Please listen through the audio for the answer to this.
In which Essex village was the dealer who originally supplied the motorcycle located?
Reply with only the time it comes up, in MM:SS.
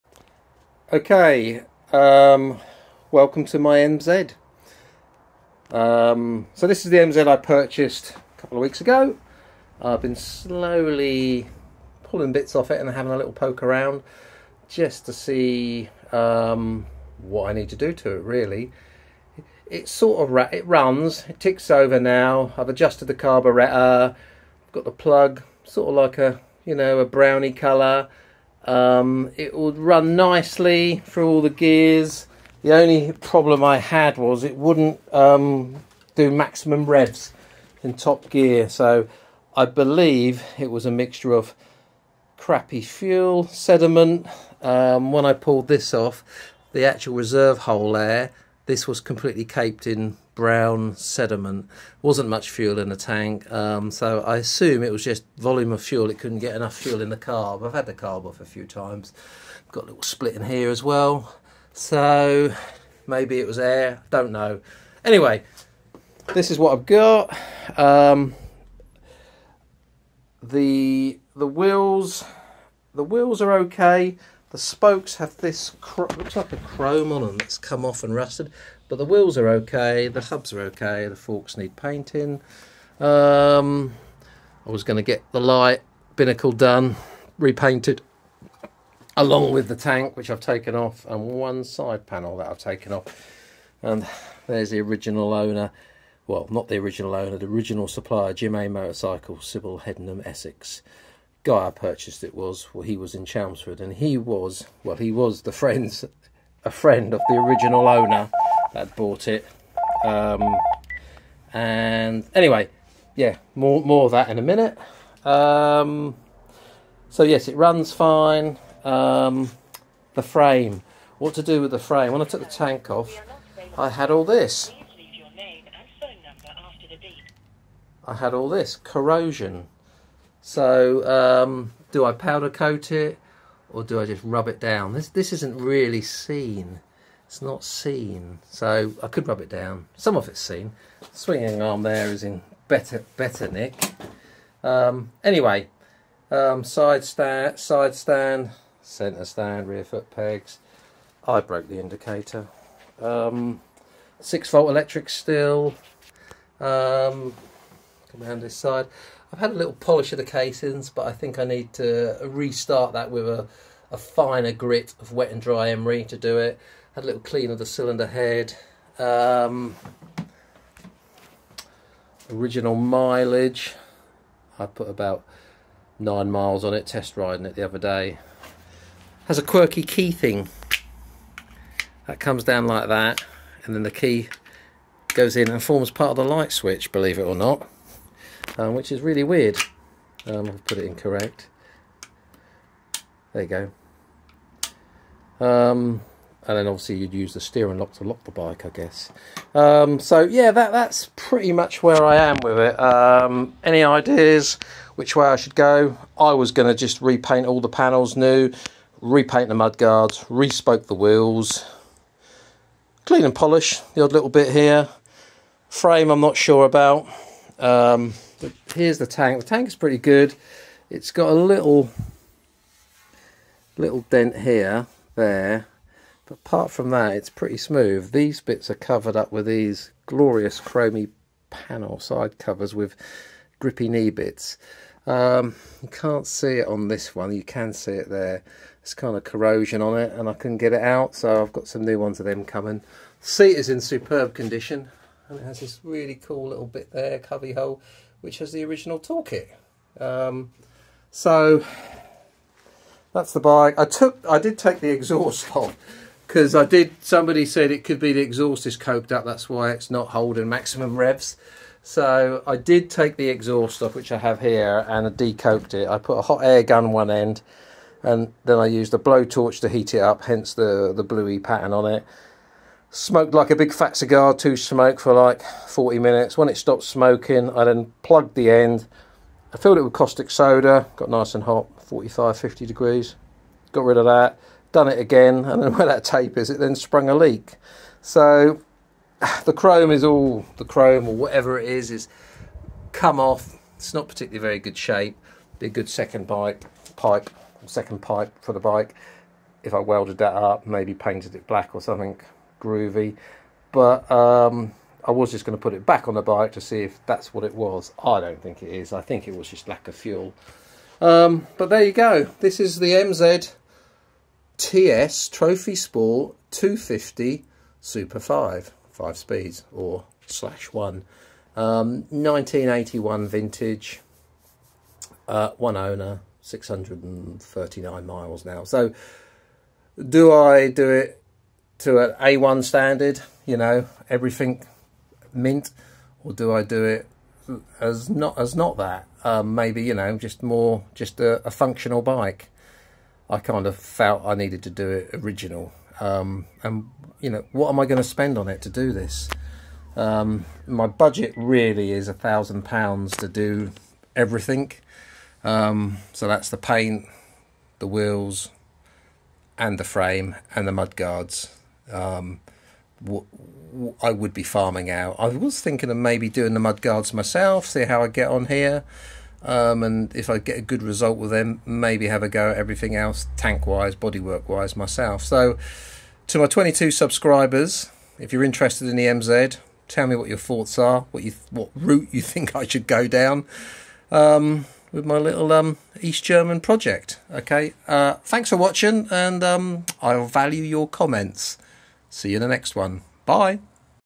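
01:39.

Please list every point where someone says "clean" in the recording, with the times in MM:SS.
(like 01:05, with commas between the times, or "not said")
02:47, 03:33.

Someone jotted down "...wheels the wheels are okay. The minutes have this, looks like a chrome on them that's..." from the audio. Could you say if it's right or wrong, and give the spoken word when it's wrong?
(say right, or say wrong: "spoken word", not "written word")
wrong: "spokes", not "minutes".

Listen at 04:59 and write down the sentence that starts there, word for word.
If I welded that up, maybe painted it black or something, groovy.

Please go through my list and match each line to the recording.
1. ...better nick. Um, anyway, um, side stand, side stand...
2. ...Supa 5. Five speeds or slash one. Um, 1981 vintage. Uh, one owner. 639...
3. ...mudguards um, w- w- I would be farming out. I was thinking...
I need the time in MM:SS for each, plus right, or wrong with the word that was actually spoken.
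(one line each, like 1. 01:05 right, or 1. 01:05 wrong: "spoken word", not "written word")
1. 02:23 right
2. 05:17 right
3. 06:00 wrong: "guards", not "mudguards".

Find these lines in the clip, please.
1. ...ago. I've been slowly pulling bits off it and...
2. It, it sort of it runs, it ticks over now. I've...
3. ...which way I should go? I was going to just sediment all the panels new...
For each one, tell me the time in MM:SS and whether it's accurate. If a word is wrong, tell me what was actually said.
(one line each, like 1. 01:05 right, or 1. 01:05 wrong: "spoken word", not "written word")
1. 00:08 right
2. 00:19 right
3. 03:24 wrong: "repaint", not "sediment".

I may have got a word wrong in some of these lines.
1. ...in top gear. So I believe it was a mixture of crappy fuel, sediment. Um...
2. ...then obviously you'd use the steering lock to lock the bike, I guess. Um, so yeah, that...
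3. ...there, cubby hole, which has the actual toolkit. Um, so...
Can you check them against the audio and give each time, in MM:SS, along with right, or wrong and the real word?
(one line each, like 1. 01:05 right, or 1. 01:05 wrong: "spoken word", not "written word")
1. 00:37 right
2. 03:16 right
3. 04:06 wrong: "original", not "actual".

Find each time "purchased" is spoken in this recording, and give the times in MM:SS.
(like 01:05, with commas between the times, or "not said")
00:07, 01:41.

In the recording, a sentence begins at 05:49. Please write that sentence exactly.
Um, my budget really is a thousand pounds to do everything.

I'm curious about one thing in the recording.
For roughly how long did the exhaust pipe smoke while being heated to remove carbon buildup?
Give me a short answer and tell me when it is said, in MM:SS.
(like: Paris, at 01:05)
40 minutes, at 04:35.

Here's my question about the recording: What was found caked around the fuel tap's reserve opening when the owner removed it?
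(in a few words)
Brown sediment.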